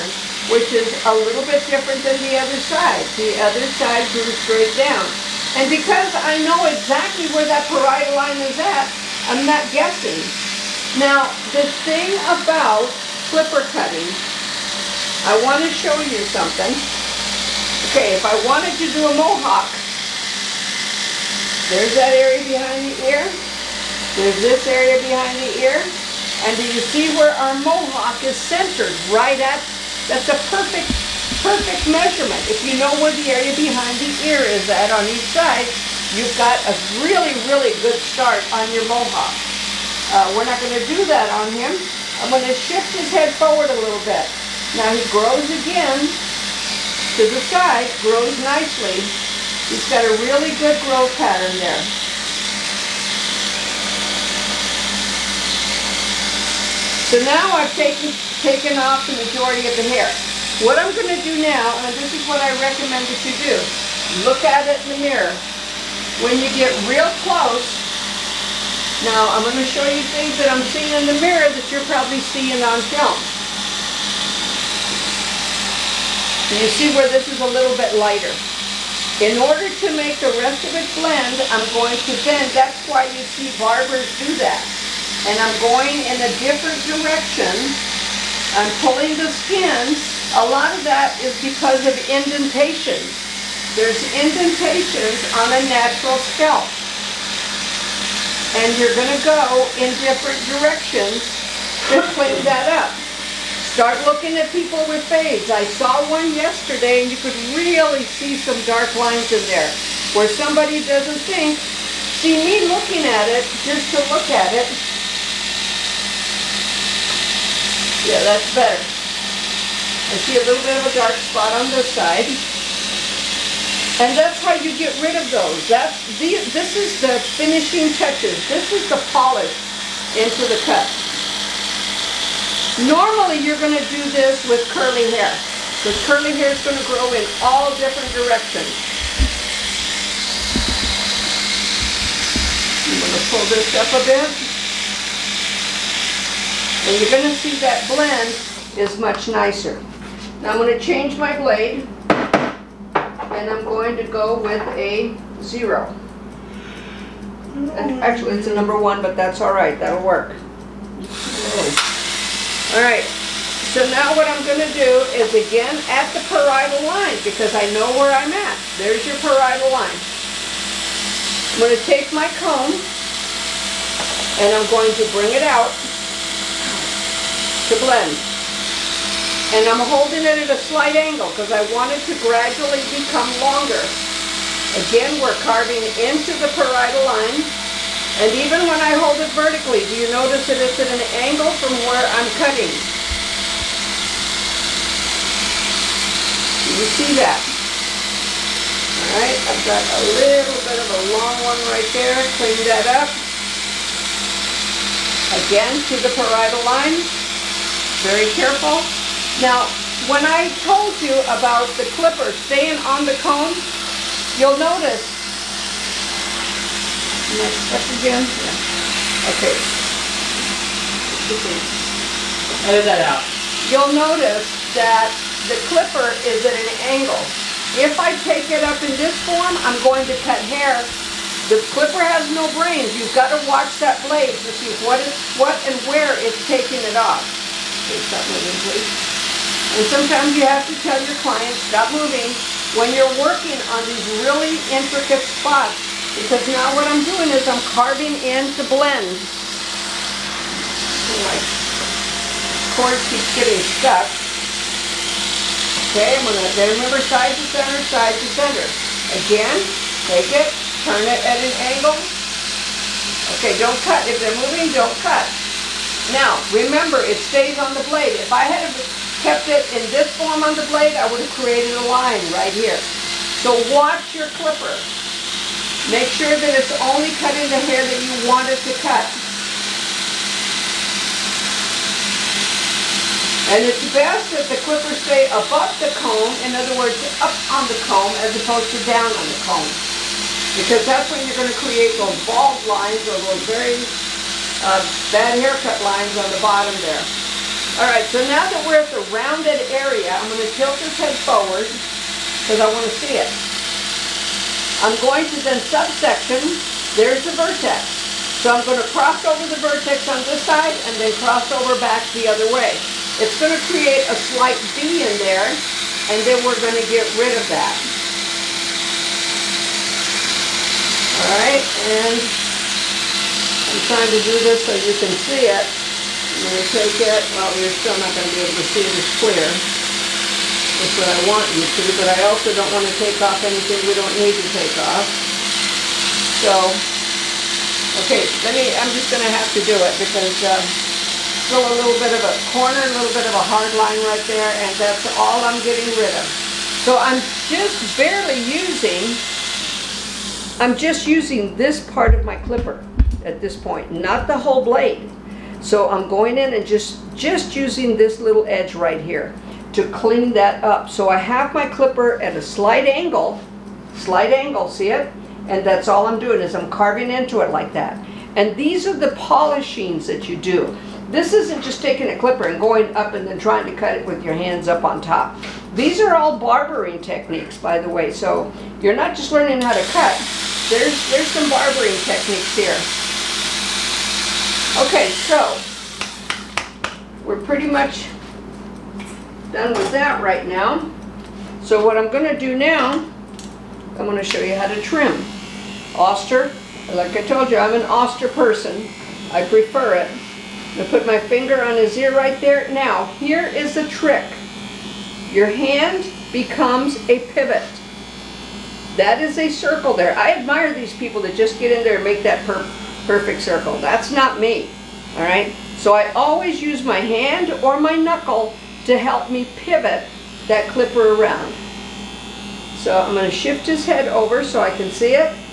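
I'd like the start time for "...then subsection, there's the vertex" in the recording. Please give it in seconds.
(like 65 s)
305 s.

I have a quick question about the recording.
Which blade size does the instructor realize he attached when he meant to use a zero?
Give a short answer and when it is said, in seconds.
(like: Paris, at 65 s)
number one, at 158 s.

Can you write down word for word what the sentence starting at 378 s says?
So you're not just learning how to cut.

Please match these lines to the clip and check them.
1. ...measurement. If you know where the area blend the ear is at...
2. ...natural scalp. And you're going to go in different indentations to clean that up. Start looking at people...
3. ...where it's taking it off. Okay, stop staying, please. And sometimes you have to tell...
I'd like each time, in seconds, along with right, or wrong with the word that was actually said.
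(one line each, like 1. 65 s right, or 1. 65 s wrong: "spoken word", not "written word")
1. 31 s wrong: "behind", not "blend"
2. 95 s wrong: "directions", not "indentations"
3. 235 s wrong: "moving", not "staying".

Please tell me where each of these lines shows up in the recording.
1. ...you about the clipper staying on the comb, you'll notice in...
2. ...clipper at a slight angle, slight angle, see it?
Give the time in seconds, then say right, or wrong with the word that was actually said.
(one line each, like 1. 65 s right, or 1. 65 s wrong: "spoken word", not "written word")
1. 211 s right
2. 361 s right.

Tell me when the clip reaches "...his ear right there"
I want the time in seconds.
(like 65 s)
401 s.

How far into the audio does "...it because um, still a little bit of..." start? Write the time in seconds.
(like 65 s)
339 s.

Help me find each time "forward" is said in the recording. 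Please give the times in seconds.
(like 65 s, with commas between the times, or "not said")
43 s, 301 s.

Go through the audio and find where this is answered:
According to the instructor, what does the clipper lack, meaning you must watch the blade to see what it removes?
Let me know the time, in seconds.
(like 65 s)
232 s.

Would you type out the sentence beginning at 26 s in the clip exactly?
And do you see where our mohawk is centered?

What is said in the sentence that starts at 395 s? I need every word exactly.
Oster, like I told you, I'm an Oster person.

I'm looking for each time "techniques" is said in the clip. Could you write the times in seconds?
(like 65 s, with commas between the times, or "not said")
377 s, 382 s.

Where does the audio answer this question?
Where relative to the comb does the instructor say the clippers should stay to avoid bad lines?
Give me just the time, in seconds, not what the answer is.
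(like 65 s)
285 s.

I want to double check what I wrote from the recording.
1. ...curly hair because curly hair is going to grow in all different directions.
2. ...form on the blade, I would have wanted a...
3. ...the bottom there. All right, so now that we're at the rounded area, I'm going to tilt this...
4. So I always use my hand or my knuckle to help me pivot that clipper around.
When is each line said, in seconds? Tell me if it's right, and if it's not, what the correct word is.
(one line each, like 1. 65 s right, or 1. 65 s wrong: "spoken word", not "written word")
1. 134 s right
2. 270 s wrong: "created", not "wanted"
3. 296 s right
4. 415 s right.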